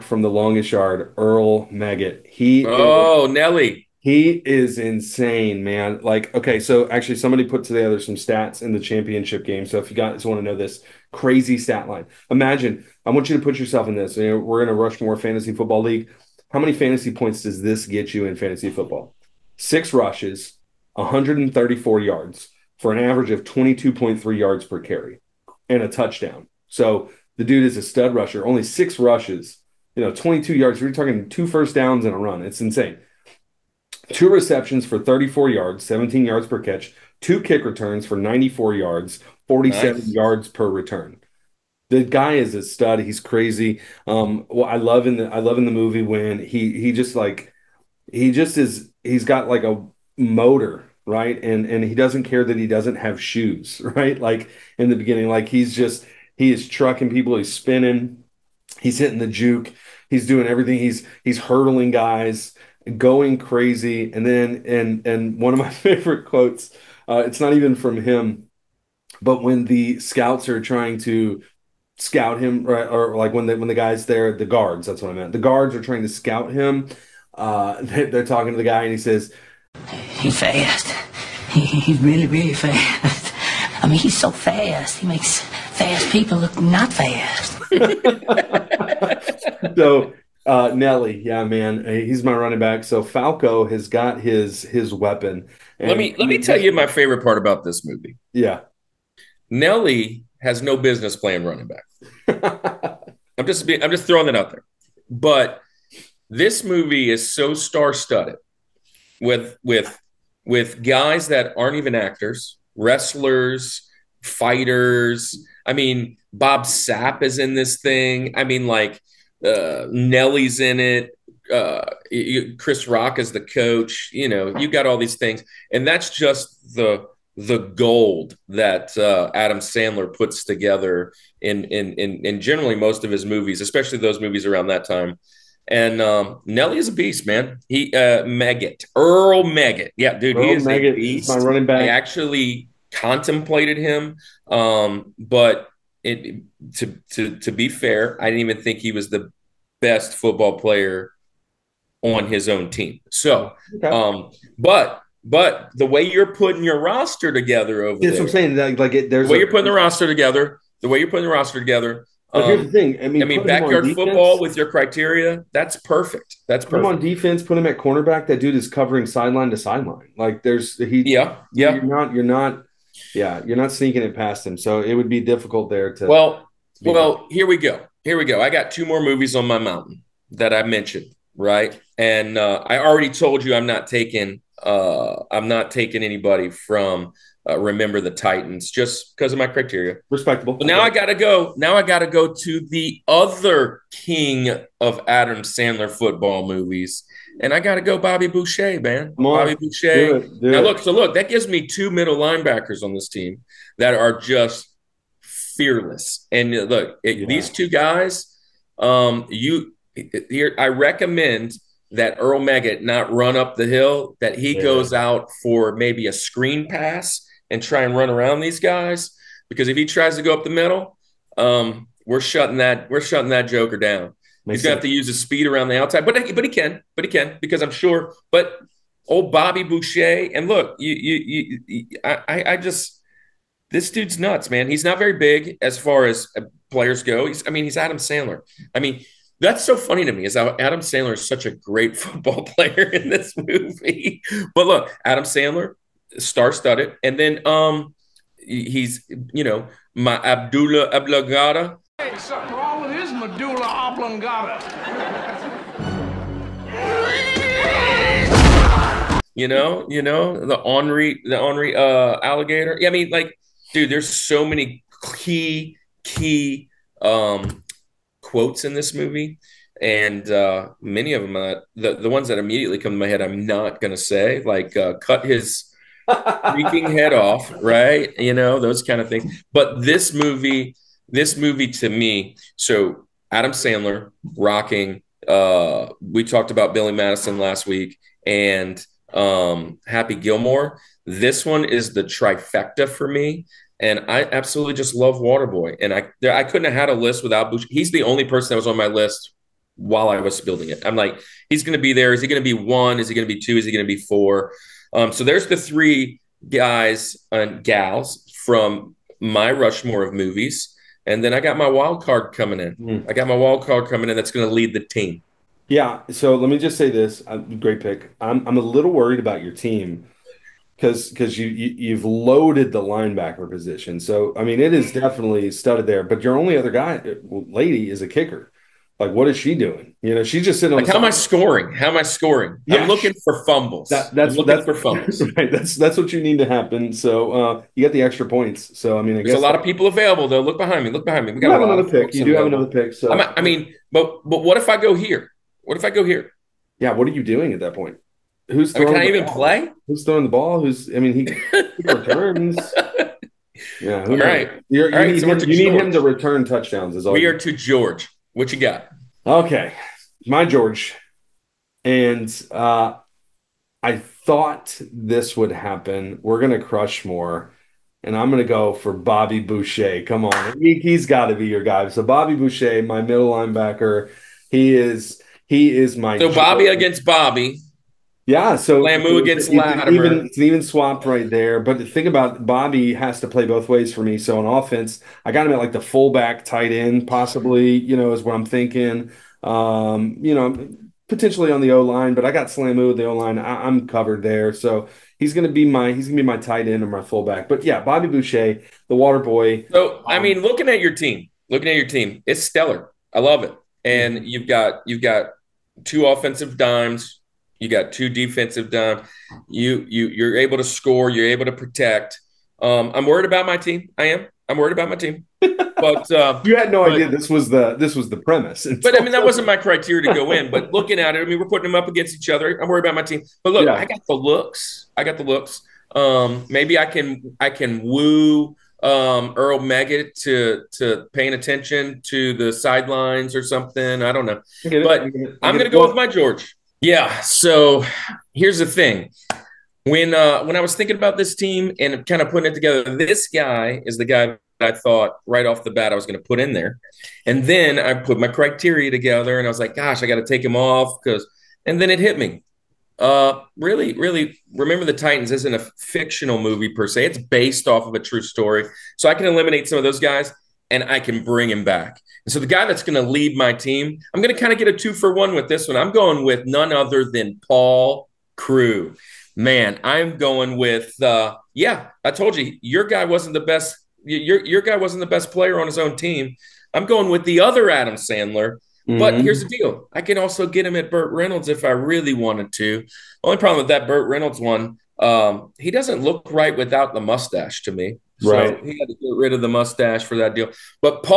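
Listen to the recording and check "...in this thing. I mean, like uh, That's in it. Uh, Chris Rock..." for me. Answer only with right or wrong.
wrong.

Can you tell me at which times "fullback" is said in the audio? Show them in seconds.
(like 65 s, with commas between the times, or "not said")
385 s, 397 s.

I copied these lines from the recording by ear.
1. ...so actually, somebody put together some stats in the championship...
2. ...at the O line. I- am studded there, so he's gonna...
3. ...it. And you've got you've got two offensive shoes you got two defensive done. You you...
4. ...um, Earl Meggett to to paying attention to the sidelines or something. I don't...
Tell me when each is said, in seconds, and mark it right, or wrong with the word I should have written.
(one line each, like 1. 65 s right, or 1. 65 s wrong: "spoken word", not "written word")
1. 6 s right
2. 392 s wrong: "covered", not "studded"
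3. 403 s wrong: "dimes", not "shoes"
4. 428 s right.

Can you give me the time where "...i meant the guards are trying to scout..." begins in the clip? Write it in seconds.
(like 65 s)
75 s.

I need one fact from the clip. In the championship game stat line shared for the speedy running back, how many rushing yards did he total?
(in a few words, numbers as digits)
134.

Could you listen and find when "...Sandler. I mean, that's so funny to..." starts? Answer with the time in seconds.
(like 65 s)
237 s.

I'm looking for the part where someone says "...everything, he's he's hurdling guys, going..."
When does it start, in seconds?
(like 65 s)
60 s.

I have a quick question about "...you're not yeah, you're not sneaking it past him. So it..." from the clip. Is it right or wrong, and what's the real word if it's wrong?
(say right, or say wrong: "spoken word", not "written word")
right.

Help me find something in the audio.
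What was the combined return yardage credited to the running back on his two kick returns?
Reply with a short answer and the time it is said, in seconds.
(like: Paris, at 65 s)
94, at 38 s.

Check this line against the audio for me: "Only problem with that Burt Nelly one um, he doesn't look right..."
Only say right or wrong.
wrong.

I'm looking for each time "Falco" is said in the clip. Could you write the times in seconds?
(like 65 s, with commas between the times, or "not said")
93 s.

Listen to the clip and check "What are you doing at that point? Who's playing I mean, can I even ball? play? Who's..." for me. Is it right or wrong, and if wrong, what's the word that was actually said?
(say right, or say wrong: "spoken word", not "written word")
wrong: "throwing", not "playing".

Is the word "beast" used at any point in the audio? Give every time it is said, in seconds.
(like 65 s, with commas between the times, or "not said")
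136 s, 140 s.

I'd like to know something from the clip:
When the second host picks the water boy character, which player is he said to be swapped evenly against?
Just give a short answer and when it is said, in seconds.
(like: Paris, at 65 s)
Lattimer, at 379 s.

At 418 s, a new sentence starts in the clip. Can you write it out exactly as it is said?
but I mean that wasn't my criteria to go in.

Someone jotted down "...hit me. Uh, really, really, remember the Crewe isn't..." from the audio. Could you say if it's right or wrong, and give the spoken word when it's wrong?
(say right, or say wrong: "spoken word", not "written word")
wrong: "Titans", not "Crewe".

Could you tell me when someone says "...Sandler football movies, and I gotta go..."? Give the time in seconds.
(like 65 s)
195 s.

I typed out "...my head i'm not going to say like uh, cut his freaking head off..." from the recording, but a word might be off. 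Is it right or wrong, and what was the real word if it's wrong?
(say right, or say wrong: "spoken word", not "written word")
right.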